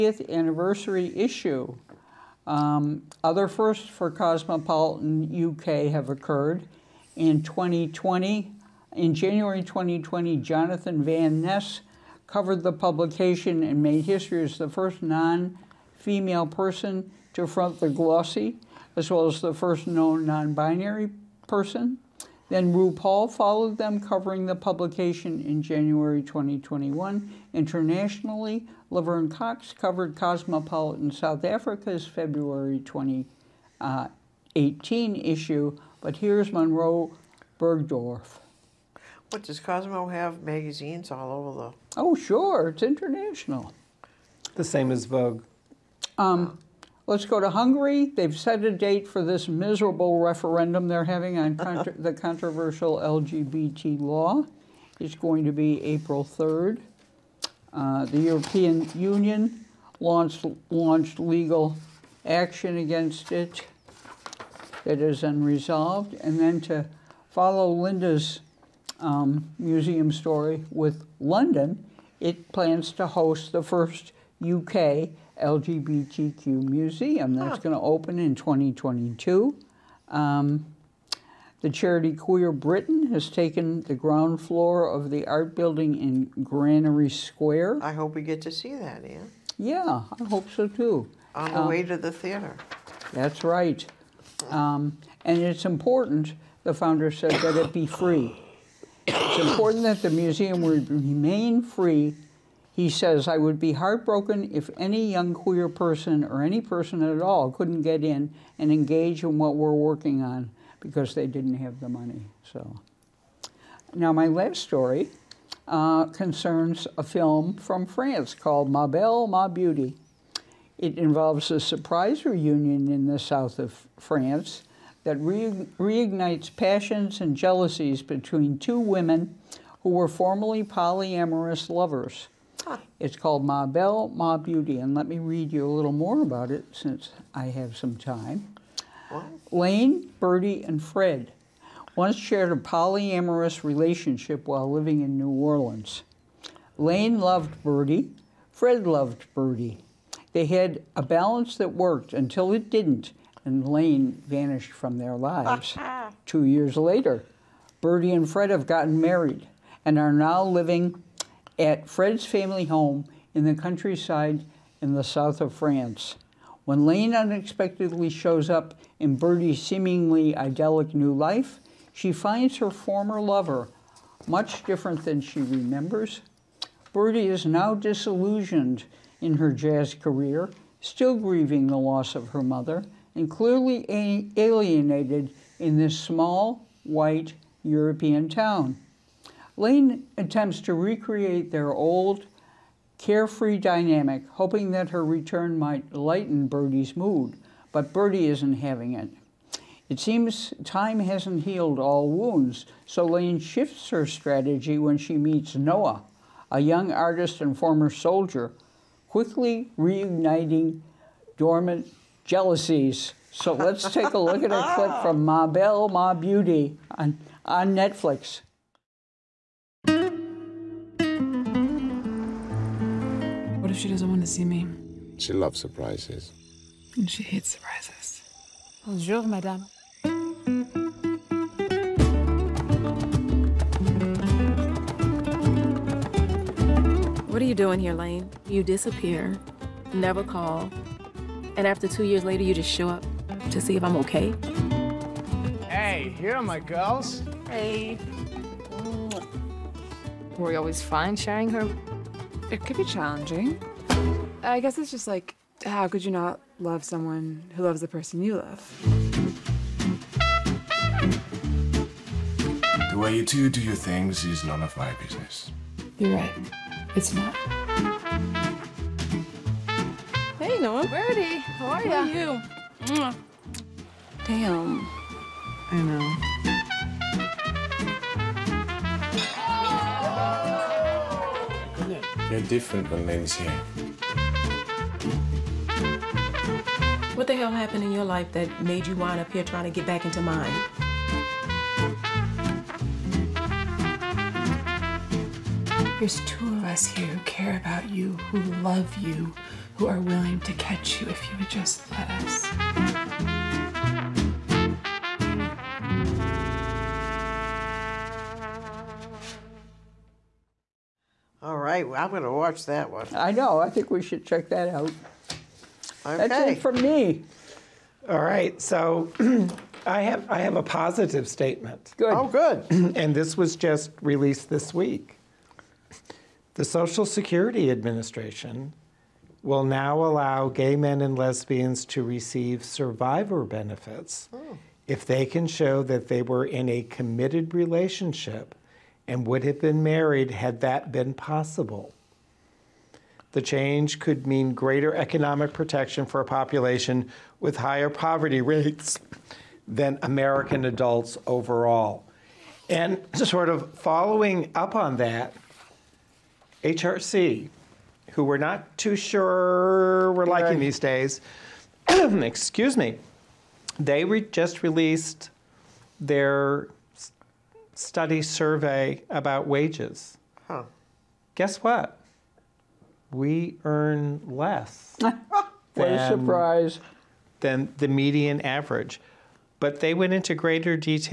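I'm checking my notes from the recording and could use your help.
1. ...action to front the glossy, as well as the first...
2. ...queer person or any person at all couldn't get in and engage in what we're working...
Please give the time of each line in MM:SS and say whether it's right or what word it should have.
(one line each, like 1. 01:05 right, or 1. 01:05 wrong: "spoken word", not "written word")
1. 00:16 wrong: "person", not "action"
2. 01:45 right.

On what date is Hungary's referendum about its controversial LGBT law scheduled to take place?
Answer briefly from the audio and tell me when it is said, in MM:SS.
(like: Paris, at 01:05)
April 3rd, at 00:55.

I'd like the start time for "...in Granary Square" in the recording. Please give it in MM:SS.
01:26.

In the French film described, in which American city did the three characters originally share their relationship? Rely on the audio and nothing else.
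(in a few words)
New Orleans.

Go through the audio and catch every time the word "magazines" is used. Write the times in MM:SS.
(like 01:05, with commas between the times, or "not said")
00:40.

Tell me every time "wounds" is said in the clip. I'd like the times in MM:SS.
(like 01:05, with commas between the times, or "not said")
03:22.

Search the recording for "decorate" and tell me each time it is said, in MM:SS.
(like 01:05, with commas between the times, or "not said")
not said.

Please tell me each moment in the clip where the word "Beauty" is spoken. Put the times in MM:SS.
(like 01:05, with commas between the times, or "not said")
01:59, 02:14, 03:36.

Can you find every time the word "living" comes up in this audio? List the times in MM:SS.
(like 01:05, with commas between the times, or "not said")
02:24, 02:40.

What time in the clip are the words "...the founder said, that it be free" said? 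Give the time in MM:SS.
01:36.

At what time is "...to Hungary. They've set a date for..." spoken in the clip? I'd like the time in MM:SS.
00:47.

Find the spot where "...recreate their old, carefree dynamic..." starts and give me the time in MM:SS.
03:10.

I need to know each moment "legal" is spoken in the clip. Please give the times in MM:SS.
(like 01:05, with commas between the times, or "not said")
01:01.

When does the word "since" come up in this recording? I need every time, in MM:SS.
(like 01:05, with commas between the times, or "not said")
02:16.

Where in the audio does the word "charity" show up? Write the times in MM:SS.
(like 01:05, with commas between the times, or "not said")
01:21.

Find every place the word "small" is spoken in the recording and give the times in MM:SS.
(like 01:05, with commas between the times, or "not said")
03:05.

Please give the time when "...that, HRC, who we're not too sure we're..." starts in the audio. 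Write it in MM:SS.
05:54.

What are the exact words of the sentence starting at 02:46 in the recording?
When Lane unexpectedly shows up in Bertie's seemingly idyllic new life, she finds her former lover much different than she remembers.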